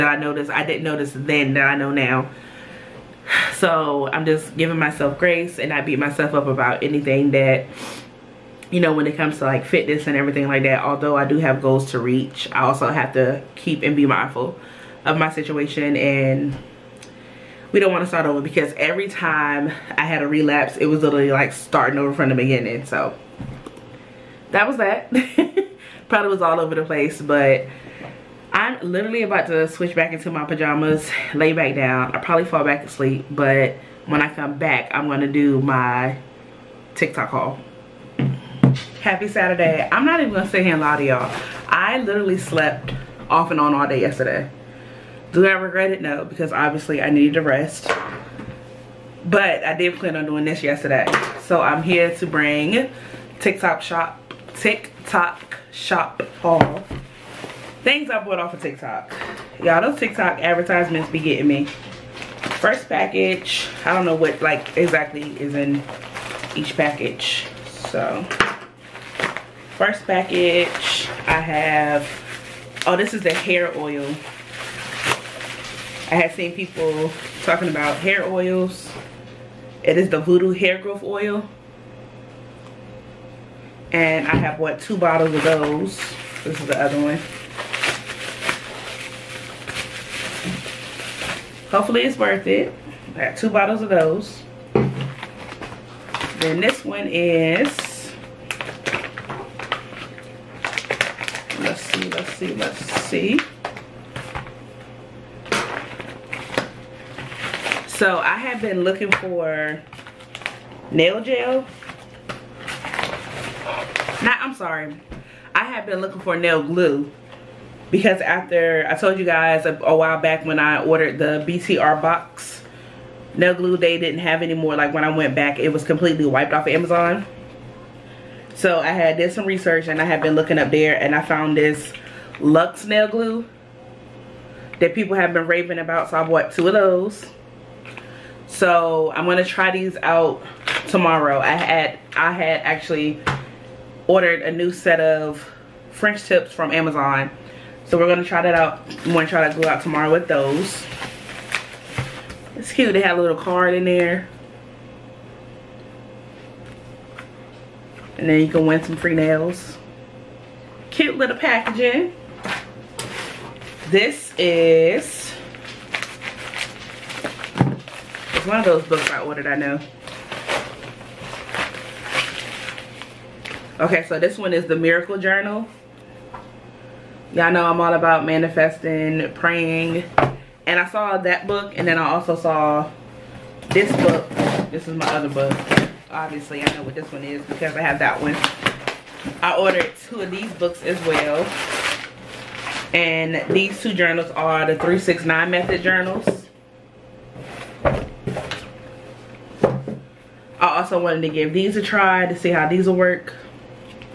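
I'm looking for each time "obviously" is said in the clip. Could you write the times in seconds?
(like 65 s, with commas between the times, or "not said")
46 s, 186 s.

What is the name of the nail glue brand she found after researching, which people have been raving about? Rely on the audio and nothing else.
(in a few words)
Lux.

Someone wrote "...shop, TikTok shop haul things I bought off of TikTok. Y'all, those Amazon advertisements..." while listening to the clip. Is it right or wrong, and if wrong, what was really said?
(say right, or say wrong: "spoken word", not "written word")
wrong: "TikTok", not "Amazon".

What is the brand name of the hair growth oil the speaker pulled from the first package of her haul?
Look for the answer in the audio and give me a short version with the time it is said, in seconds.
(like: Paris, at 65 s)
Voodoo, at 80 s.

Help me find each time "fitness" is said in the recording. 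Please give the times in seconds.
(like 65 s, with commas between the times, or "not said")
9 s.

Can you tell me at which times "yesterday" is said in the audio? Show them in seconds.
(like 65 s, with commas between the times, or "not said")
44 s, 50 s.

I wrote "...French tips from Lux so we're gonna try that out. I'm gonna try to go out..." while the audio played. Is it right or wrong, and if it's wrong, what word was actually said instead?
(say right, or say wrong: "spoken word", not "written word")
wrong: "Amazon", not "Lux".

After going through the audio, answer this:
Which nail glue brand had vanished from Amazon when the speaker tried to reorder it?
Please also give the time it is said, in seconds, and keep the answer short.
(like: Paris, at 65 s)
BTArtbox, at 121 s.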